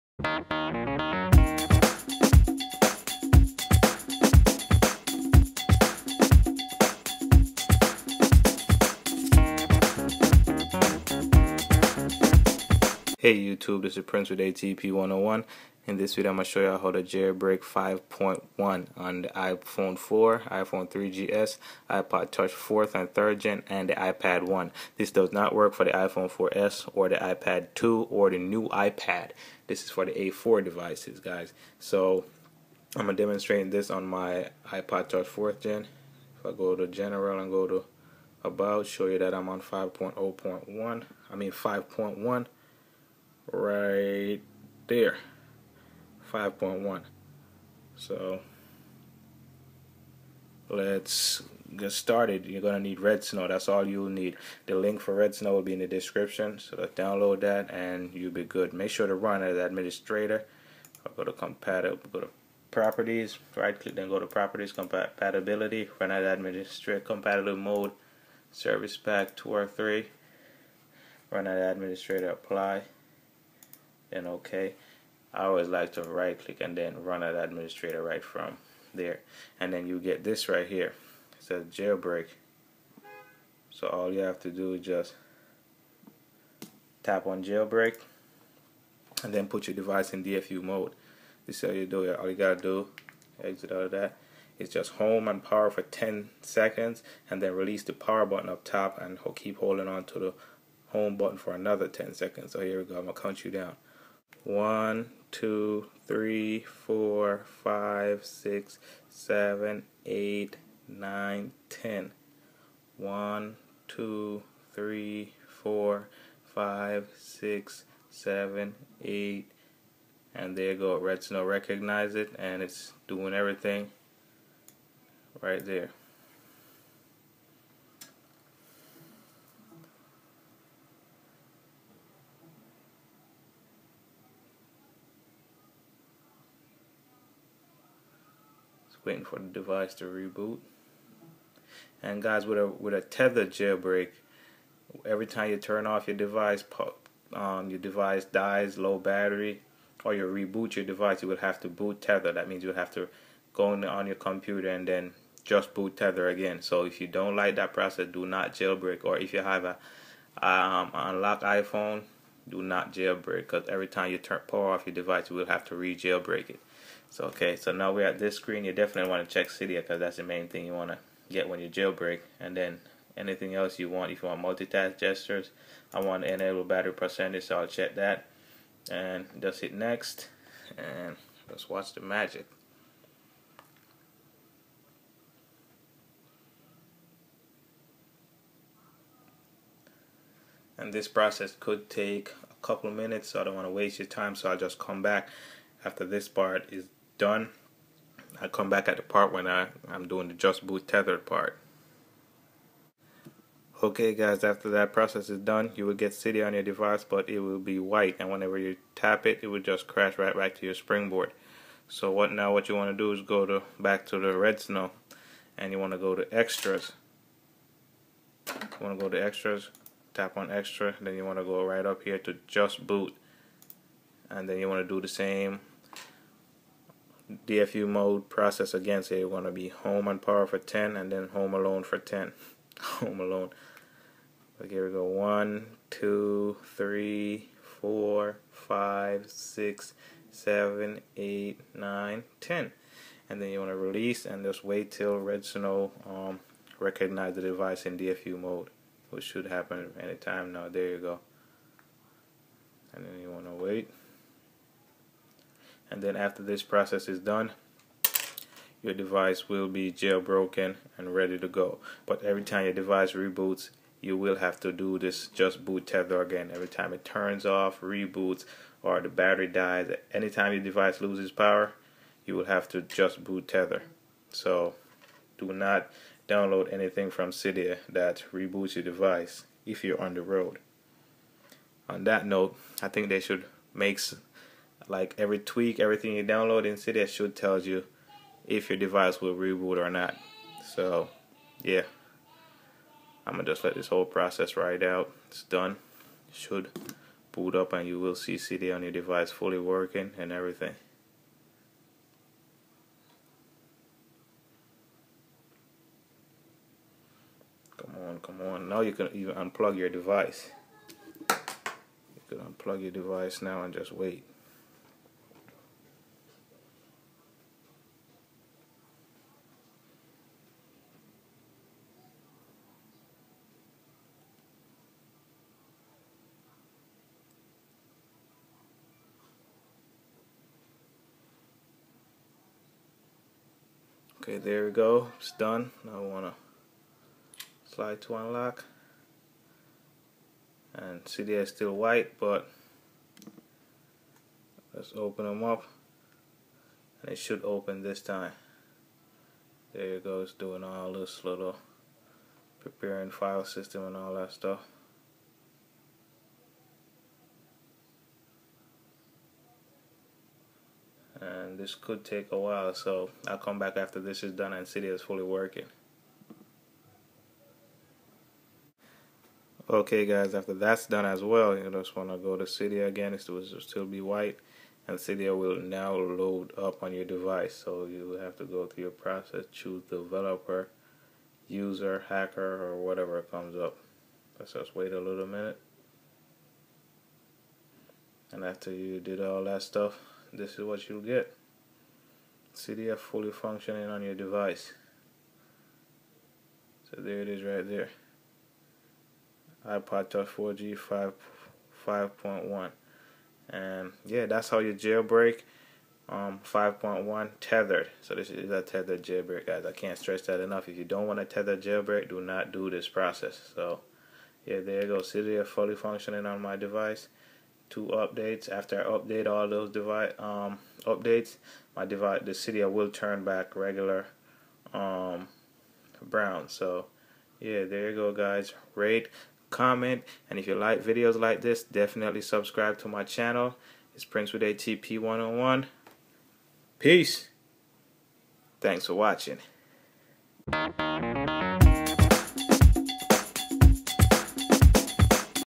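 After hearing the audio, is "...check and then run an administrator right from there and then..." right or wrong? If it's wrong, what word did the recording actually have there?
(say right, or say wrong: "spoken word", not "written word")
wrong: "click", not "check".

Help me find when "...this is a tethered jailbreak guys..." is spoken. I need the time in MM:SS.
06:48.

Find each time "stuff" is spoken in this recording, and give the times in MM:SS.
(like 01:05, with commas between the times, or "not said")
05:54, 06:29.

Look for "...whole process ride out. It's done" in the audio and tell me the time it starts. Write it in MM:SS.
04:53.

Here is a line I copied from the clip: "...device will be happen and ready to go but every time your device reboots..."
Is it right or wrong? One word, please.
wrong.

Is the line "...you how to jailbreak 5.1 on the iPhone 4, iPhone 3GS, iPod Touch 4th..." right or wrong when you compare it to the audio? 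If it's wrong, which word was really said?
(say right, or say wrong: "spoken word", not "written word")
right.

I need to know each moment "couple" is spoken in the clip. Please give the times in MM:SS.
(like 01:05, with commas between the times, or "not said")
03:12.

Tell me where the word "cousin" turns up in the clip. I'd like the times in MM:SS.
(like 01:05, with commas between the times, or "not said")
not said.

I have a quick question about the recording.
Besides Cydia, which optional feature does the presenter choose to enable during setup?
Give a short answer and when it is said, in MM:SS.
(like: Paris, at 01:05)
battery percentage, at 02:56.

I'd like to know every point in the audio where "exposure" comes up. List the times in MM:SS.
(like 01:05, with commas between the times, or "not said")
not said.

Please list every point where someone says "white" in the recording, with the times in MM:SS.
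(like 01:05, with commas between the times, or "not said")
03:27, 05:41, 06:14.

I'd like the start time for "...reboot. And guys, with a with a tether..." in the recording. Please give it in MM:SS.
02:20.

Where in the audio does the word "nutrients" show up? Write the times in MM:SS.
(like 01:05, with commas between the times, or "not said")
not said.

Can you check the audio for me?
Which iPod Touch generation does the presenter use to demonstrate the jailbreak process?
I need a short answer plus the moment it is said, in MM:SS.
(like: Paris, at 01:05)
4th Gen, at 00:34.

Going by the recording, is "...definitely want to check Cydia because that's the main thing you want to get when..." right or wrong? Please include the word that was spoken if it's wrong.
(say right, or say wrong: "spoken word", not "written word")
right.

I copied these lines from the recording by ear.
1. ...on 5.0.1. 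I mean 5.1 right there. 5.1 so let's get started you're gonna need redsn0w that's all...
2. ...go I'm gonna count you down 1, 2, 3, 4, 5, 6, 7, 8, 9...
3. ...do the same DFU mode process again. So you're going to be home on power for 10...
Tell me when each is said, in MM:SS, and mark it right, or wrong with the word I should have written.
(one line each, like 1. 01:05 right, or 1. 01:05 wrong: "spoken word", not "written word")
1. 00:39 right
2. 01:42 right
3. 03:44 right.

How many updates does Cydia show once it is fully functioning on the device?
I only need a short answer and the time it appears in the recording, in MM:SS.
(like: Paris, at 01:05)
2, at 06:57.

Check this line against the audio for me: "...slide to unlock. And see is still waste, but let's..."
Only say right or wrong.
wrong.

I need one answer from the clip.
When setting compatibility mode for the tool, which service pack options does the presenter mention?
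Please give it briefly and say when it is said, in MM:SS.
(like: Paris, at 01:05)
2 or 3, at 01:08.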